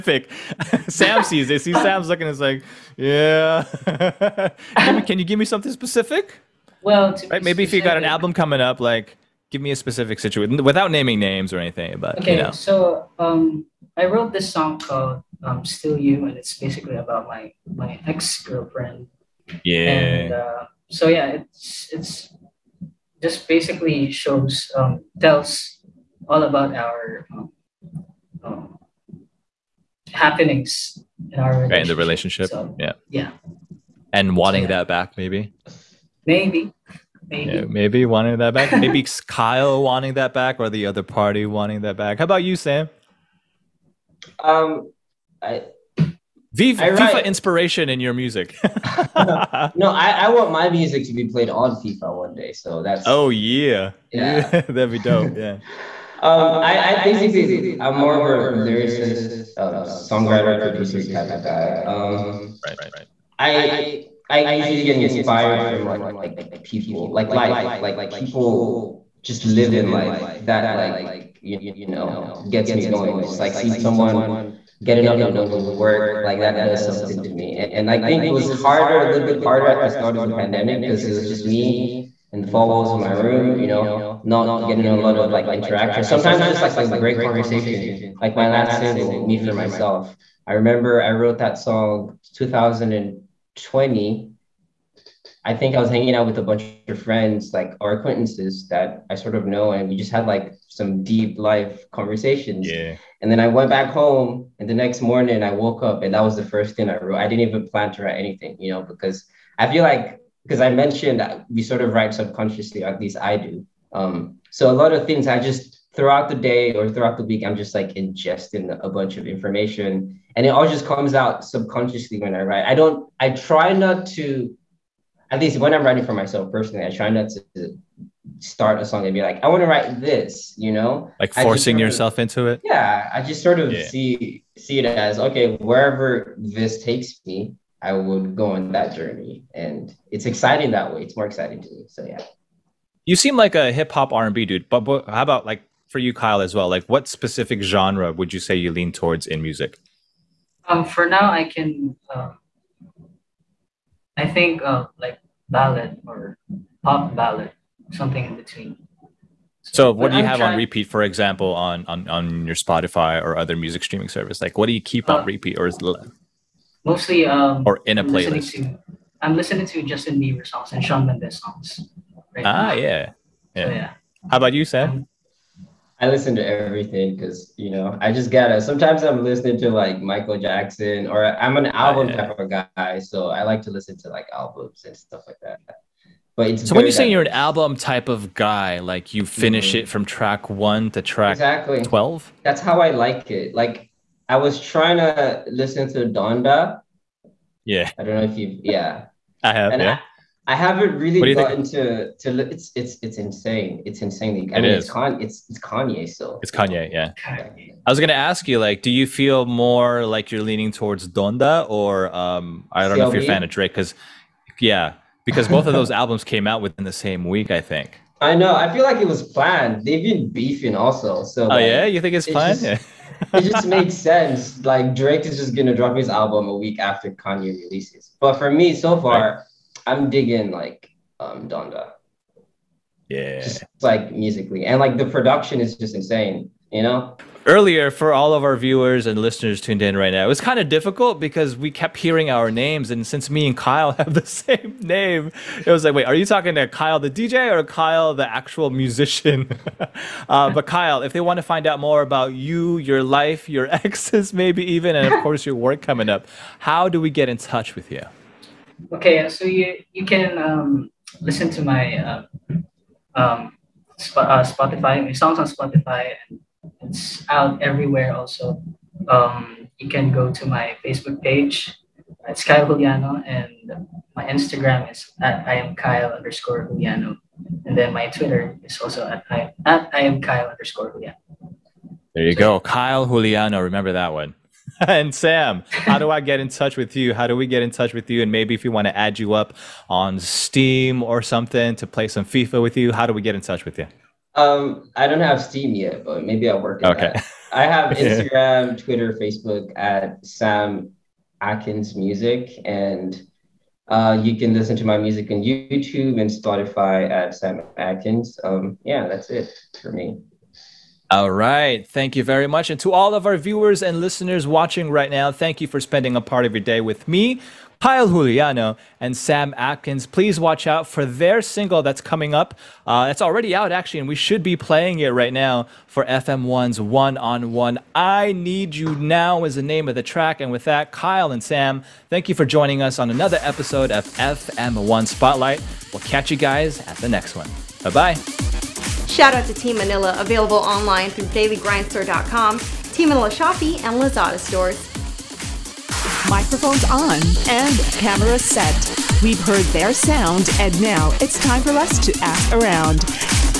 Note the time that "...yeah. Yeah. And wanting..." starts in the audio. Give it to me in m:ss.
0:32.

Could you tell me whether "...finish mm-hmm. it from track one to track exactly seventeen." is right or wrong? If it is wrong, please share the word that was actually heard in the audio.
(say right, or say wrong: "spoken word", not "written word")
wrong: "twelve", not "seventeen".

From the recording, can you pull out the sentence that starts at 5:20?
Please watch out for their single that's coming up.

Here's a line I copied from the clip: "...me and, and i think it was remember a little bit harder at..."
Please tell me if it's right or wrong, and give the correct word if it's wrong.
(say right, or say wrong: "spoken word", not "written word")
wrong: "harder", not "remember".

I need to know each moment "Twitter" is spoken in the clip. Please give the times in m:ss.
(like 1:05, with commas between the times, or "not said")
4:38, 4:58.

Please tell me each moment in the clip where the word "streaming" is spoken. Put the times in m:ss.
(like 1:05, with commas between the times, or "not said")
2:43.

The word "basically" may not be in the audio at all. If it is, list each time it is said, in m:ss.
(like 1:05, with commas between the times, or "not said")
0:16, 0:23, 0:57.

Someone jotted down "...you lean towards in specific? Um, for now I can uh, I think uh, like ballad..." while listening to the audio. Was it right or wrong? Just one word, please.
wrong.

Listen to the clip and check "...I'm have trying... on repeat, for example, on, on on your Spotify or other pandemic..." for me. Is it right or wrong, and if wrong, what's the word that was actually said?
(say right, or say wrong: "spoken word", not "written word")
wrong: "music", not "pandemic".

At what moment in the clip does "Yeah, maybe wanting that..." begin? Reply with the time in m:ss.
0:37.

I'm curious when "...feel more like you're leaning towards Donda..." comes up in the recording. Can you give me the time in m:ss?
3:29.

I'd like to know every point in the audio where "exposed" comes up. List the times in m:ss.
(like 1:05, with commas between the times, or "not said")
not said.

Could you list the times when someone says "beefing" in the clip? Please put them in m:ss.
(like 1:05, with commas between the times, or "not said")
3:40.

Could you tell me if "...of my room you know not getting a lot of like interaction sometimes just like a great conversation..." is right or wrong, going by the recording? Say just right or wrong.
right.